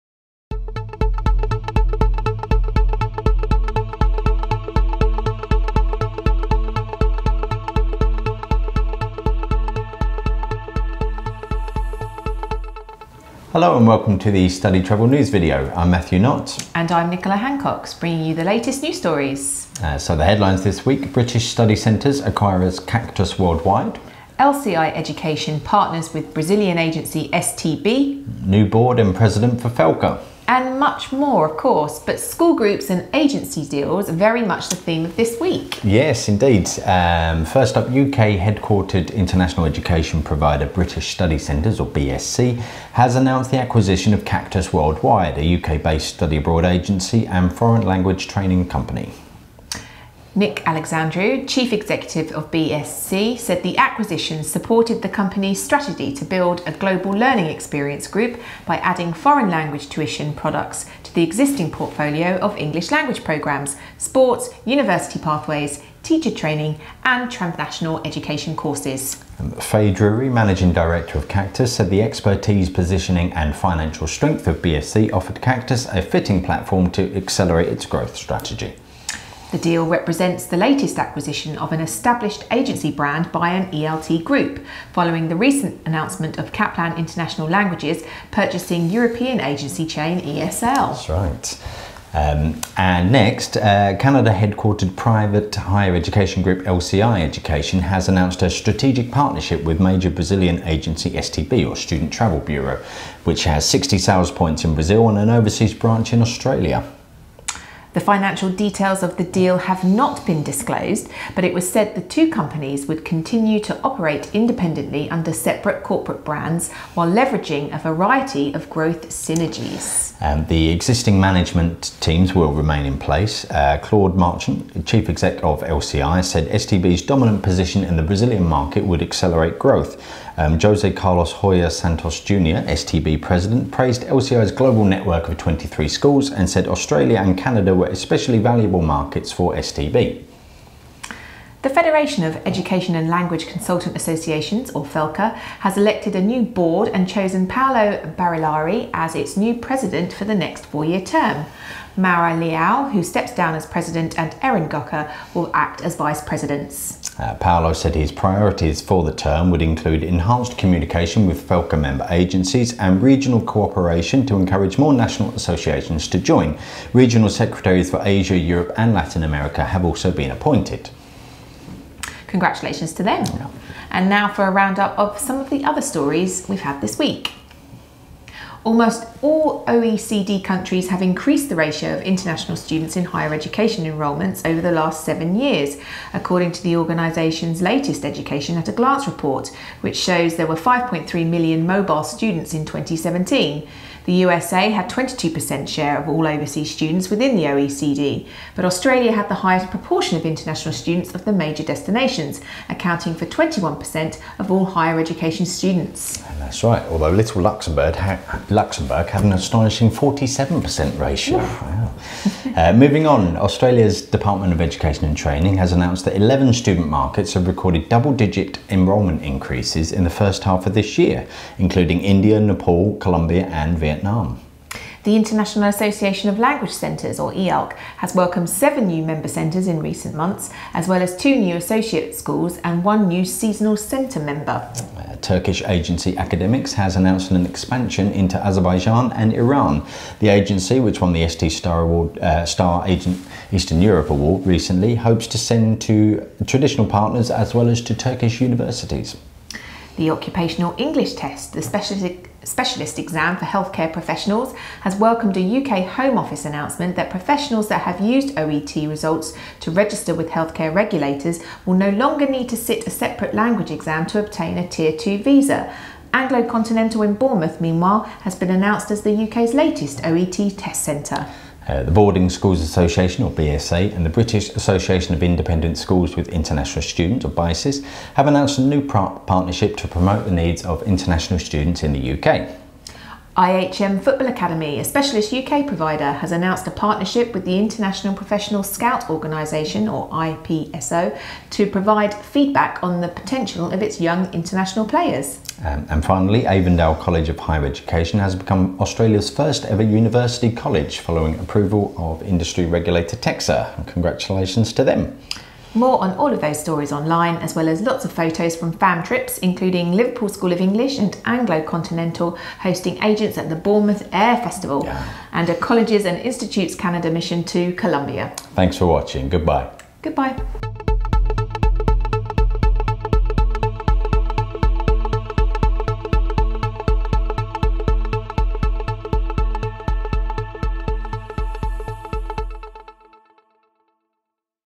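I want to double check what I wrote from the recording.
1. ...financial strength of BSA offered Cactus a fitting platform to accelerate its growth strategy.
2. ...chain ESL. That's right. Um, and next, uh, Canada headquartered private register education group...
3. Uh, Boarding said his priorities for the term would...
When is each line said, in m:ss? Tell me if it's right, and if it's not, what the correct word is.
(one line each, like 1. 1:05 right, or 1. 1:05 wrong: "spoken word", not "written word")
1. 1:13 wrong: "BSC", not "BSA"
2. 1:29 wrong: "higher", not "register"
3. 2:37 wrong: "Paolo", not "Boarding".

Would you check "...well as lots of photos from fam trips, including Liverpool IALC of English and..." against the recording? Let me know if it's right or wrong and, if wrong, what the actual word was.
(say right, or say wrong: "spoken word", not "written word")
wrong: "School", not "IALC".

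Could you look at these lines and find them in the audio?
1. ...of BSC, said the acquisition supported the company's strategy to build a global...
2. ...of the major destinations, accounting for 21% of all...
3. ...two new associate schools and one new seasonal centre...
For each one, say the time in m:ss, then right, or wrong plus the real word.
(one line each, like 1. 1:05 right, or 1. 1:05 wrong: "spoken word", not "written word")
1. 0:52 right
2. 3:21 right
3. 3:51 right.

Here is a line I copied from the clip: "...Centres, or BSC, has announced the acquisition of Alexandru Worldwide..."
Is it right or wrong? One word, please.
wrong.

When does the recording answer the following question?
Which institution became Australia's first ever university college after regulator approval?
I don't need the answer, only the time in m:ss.
4:56.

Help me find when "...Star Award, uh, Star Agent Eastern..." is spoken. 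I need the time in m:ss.
4:01.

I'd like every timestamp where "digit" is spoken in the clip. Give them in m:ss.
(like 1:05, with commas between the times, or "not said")
3:38.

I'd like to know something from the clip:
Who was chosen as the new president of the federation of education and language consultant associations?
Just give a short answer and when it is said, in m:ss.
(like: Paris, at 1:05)
Paolo Barillari, at 2:27.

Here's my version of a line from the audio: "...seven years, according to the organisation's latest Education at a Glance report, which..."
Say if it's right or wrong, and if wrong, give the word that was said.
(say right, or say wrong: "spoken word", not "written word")
right.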